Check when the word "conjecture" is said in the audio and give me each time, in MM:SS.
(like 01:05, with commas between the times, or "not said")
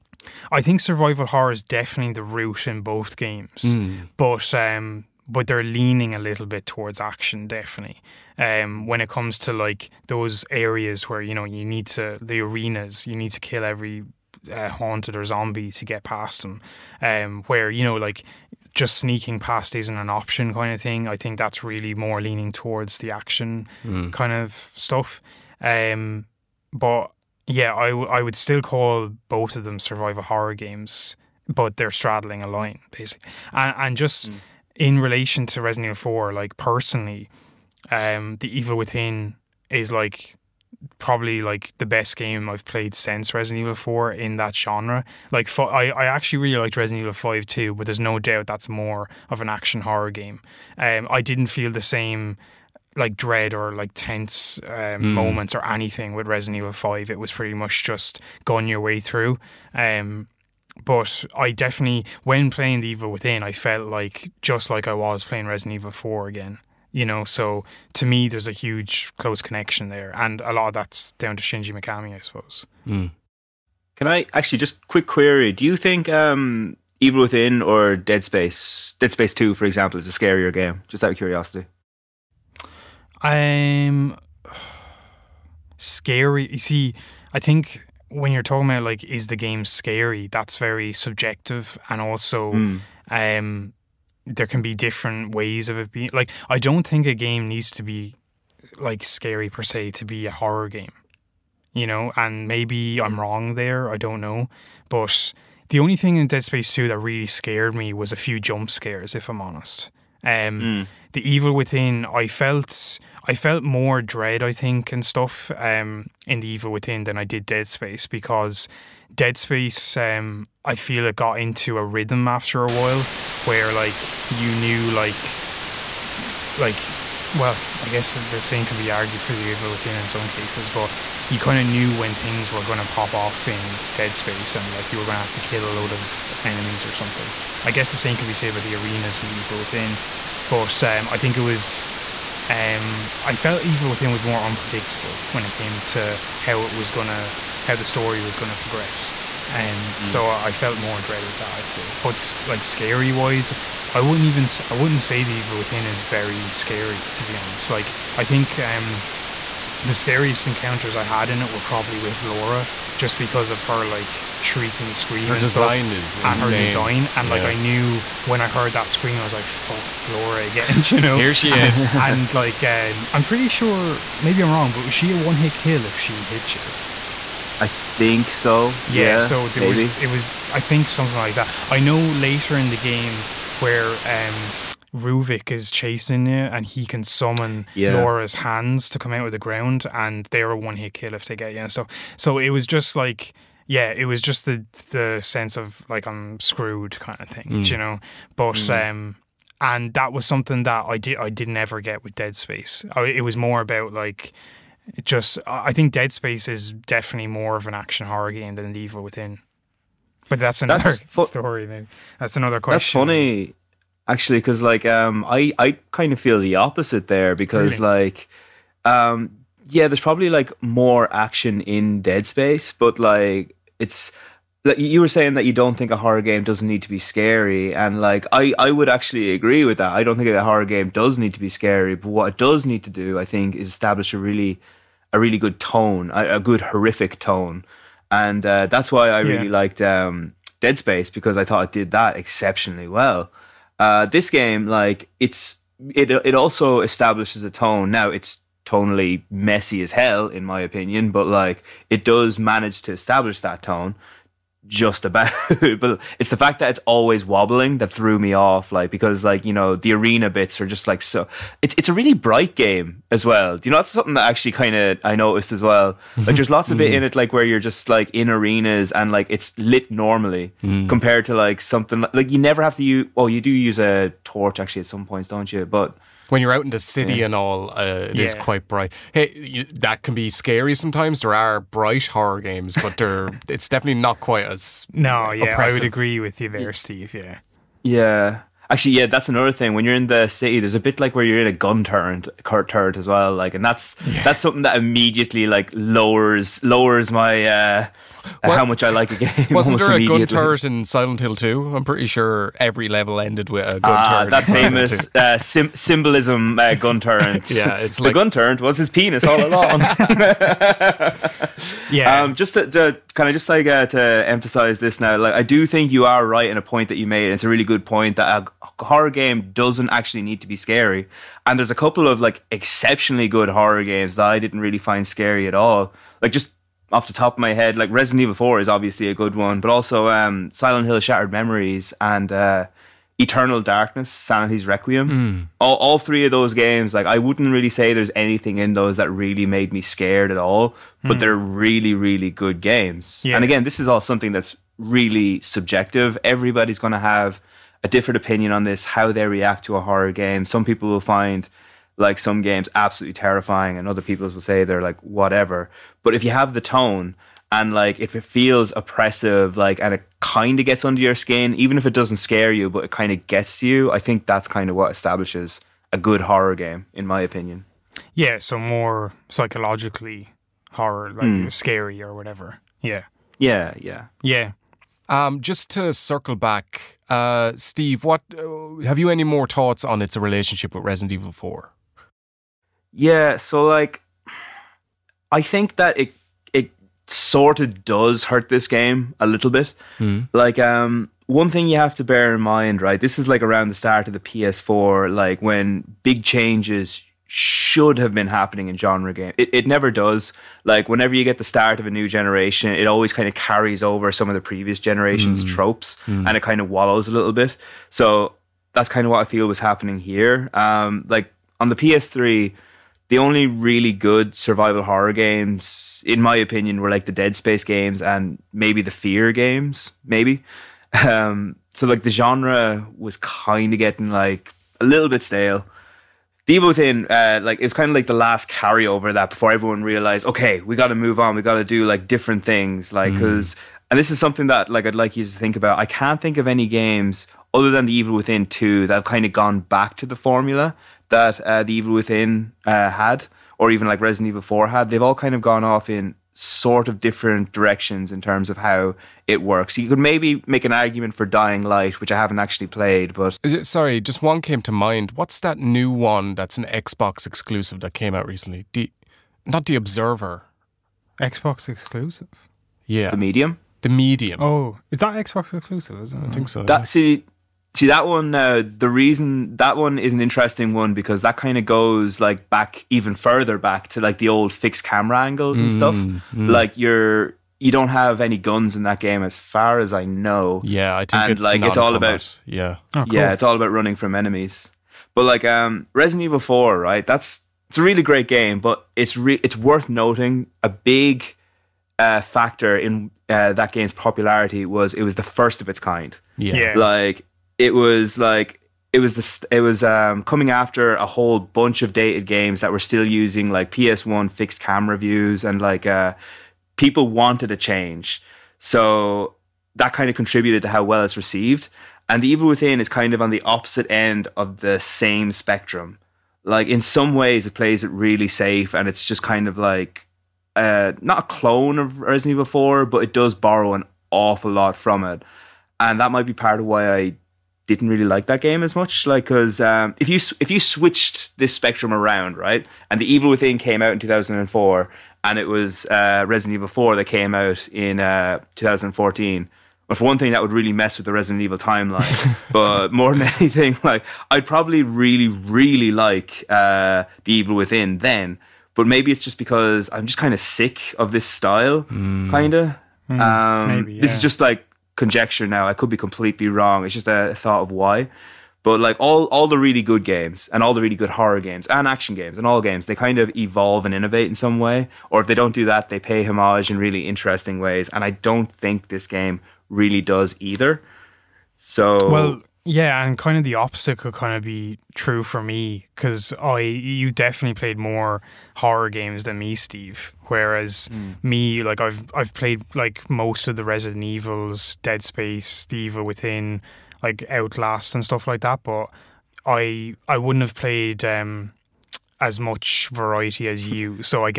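09:14.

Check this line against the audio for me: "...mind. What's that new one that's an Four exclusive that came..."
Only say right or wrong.
wrong.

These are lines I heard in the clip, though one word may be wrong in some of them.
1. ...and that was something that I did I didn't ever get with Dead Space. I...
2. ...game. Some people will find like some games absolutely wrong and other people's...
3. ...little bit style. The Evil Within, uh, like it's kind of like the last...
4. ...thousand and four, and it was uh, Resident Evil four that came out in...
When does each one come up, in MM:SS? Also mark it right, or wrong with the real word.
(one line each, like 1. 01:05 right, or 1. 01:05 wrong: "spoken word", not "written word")
1. 03:19 right
2. 05:50 wrong: "terrifying", not "wrong"
3. 07:04 wrong: "stale", not "style"
4. 08:54 right.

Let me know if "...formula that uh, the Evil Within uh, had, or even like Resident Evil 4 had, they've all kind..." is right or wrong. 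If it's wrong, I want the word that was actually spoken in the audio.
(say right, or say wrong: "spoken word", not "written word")
right.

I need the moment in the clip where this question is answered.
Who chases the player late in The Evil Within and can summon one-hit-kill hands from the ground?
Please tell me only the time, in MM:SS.
03:04.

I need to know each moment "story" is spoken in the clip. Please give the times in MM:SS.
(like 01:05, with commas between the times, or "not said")
02:27, 03:31.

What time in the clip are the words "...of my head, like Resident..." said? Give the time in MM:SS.
05:27.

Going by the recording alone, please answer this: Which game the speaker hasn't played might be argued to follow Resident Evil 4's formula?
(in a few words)
Dying Light.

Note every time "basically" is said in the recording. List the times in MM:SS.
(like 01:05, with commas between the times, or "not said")
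00:32.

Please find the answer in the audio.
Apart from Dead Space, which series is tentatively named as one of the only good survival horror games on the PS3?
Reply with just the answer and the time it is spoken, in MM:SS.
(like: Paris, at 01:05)
Fear, at 06:58.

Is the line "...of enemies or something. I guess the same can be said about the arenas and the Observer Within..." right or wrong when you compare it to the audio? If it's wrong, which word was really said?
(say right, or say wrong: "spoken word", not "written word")
wrong: "Evil", not "Observer".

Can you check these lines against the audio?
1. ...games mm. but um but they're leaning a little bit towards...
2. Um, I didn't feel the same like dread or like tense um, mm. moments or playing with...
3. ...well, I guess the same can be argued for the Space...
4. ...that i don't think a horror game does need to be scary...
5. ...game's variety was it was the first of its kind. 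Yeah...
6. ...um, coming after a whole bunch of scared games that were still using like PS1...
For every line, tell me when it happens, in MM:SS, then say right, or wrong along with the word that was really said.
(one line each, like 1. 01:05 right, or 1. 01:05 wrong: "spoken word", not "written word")
1. 00:03 right
2. 00:50 wrong: "anything", not "playing"
3. 02:07 wrong: "Evil", not "Space"
4. 03:49 right
5. 08:13 wrong: "popularity", not "variety"
6. 08:19 wrong: "dated", not "scared".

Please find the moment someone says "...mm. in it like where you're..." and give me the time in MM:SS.
04:26.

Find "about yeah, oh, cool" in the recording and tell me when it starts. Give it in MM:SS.
08:02.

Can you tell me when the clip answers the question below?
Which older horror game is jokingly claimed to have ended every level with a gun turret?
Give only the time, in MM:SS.
05:00.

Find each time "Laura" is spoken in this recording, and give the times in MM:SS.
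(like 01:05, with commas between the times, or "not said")
02:42, 02:50, 03:07.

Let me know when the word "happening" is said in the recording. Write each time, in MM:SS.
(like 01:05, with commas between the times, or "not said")
06:38, 06:49.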